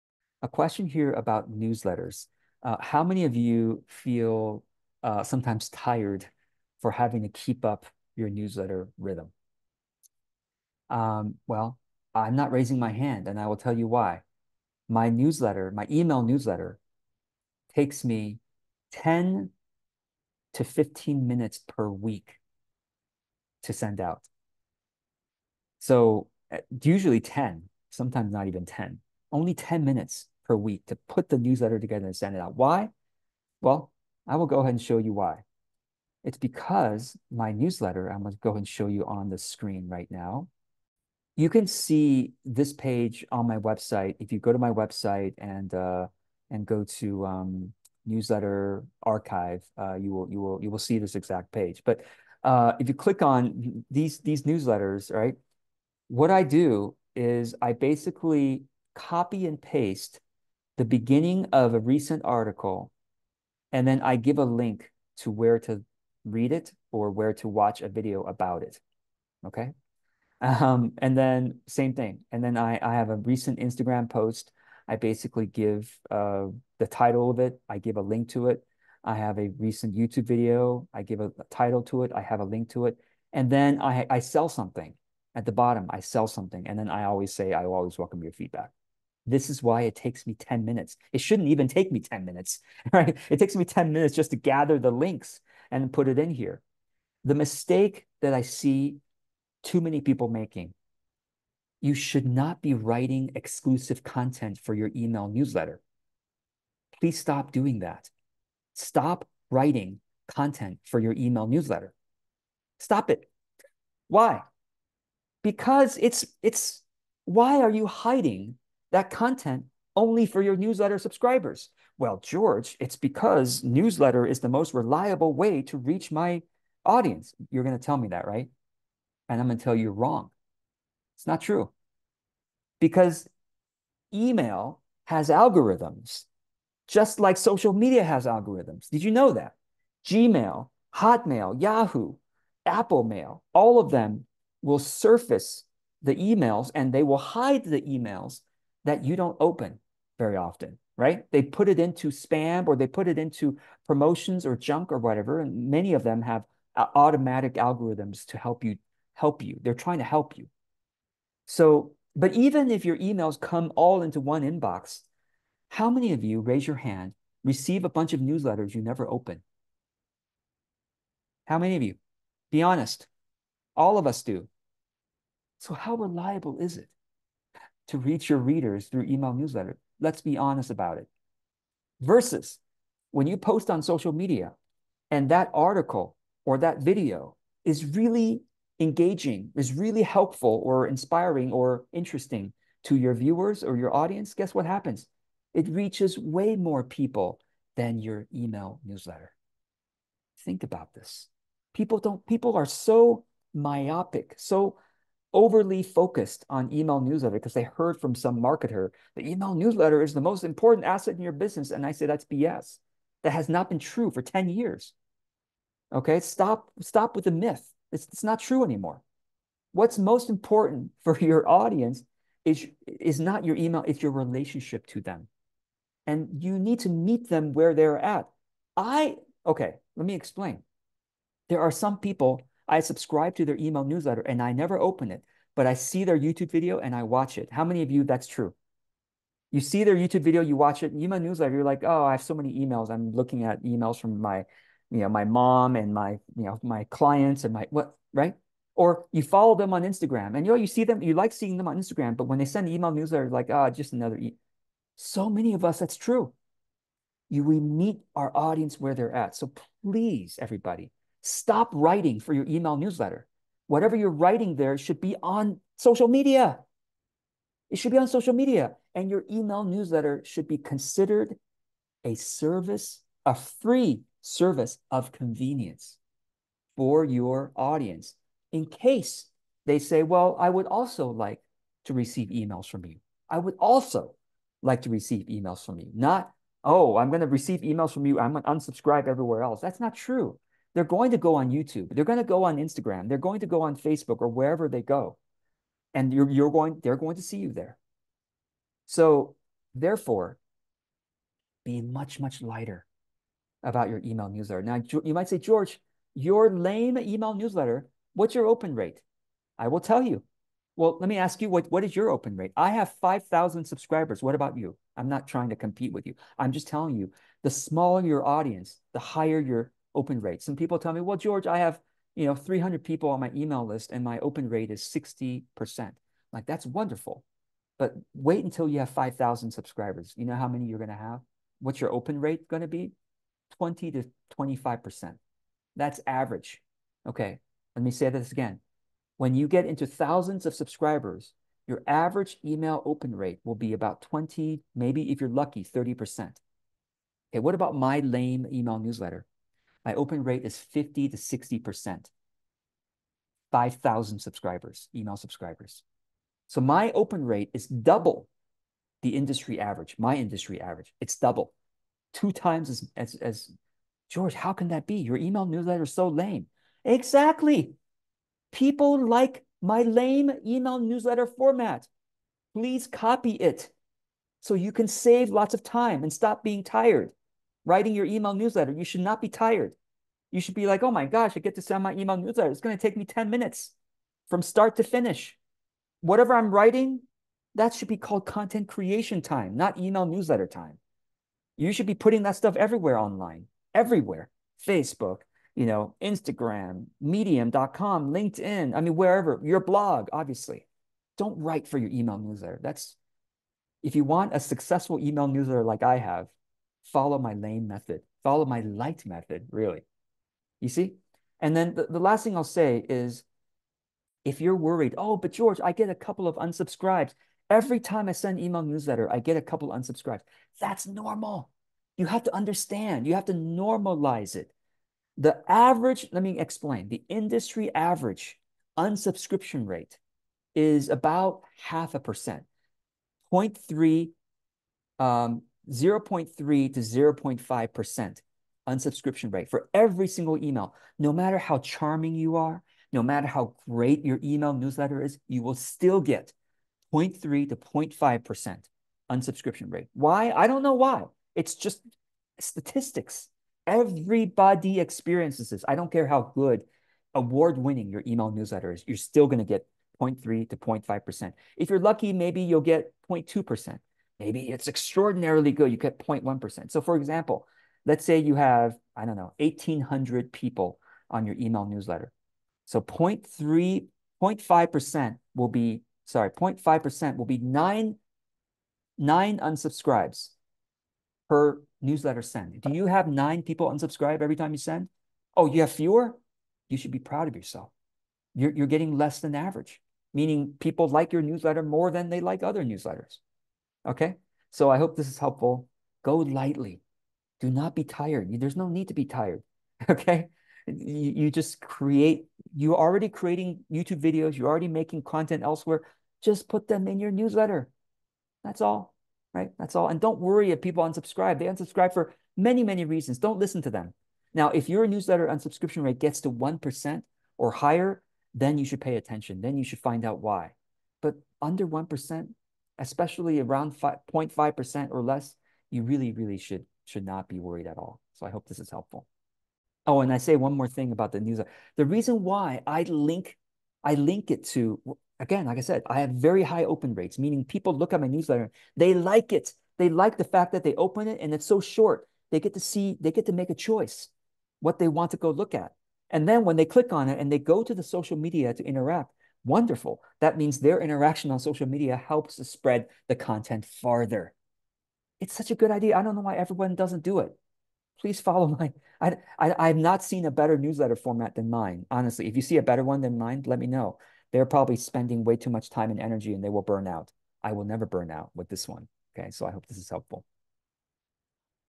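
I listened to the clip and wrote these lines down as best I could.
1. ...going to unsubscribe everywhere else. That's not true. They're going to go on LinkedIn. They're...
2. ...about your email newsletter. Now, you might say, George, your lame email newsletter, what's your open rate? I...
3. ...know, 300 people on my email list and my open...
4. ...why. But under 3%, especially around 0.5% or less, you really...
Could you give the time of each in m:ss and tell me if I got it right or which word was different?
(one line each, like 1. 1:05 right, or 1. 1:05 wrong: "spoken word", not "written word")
1. 4:48 wrong: "YouTube", not "LinkedIn"
2. 5:03 right
3. 5:22 right
4. 8:40 wrong: "1", not "3".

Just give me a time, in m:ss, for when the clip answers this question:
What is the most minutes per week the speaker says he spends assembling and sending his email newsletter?
0:20.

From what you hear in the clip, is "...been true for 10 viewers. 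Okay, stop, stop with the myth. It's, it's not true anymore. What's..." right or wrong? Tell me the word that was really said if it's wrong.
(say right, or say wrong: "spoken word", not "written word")
wrong: "years", not "viewers".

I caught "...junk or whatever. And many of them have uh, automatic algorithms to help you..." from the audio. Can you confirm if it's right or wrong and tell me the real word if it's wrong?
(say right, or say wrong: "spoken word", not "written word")
right.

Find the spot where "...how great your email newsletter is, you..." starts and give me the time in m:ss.
7:23.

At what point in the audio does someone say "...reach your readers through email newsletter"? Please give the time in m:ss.
2:57.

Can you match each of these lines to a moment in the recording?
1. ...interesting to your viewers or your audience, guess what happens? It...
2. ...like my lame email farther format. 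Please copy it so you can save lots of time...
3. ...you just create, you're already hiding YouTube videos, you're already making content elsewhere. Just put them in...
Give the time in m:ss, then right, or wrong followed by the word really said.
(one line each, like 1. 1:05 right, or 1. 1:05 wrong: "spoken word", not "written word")
1. 3:11 right
2. 6:09 wrong: "newsletter", not "farther"
3. 8:21 wrong: "creating", not "hiding".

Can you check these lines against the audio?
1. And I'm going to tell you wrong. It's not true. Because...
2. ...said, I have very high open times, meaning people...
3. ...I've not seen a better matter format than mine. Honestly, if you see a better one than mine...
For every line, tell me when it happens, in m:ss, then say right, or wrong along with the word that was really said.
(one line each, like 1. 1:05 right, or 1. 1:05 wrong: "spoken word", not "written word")
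1. 2:09 right
2. 8:55 wrong: "rates", not "times"
3. 9:19 wrong: "newsletter", not "matter".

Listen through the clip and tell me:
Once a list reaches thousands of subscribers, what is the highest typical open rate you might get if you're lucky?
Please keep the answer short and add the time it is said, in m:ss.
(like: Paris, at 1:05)
30%, at 5:45.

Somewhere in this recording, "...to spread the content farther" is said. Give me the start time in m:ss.
9:12.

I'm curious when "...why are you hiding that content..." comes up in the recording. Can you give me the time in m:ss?
1:57.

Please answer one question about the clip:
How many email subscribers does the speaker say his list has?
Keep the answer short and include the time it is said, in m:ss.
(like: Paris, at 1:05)
5,000, at 5:13.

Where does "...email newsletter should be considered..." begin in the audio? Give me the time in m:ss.
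4:29.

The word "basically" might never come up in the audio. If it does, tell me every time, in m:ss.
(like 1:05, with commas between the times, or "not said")
0:57, 1:14.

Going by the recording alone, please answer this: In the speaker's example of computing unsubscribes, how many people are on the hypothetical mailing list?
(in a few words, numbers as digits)
1,800.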